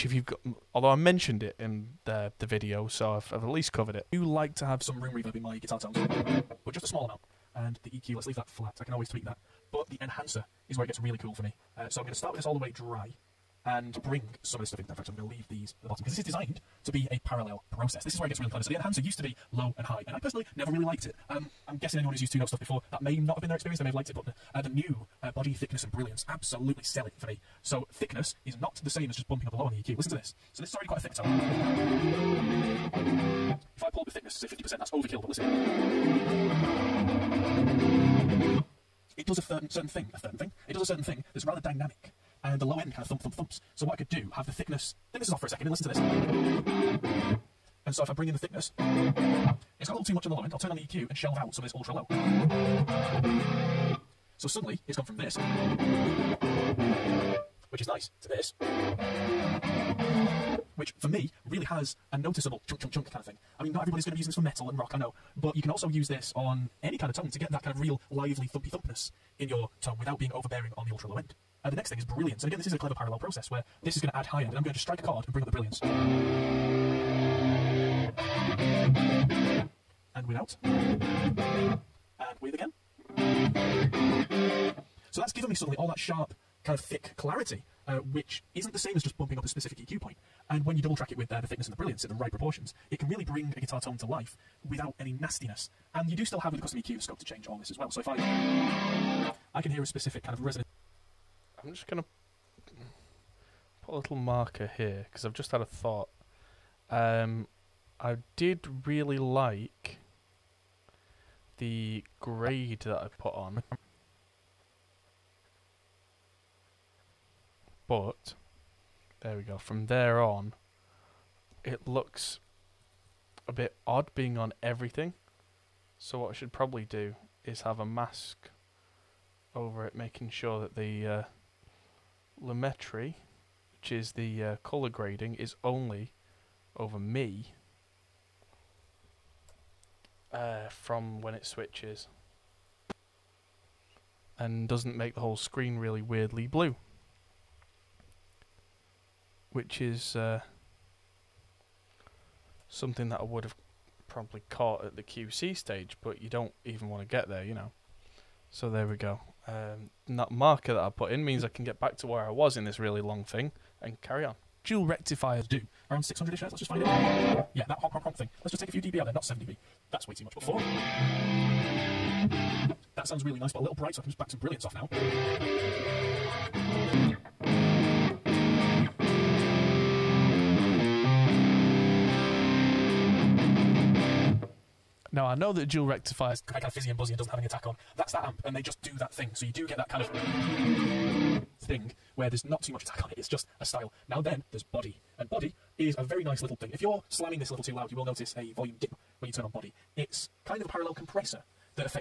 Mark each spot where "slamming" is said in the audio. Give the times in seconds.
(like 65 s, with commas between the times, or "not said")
197 s.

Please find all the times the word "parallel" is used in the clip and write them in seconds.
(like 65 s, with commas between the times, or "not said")
17 s, 72 s, 200 s.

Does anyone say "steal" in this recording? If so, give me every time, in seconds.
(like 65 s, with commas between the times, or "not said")
not said.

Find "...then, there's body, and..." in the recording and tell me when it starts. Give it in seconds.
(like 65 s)
194 s.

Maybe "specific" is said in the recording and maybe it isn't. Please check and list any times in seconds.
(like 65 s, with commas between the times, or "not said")
89 s, 99 s.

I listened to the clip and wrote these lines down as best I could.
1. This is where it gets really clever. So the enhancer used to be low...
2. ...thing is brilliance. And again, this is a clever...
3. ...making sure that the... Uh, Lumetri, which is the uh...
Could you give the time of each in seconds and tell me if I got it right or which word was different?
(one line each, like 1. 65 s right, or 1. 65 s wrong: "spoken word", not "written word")
1. 18 s right
2. 71 s right
3. 129 s right.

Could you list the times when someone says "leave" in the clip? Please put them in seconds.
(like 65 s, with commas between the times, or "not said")
8 s, 15 s.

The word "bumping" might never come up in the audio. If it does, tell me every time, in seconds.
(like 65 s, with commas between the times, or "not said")
29 s, 89 s.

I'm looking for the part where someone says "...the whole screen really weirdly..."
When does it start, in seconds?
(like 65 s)
145 s.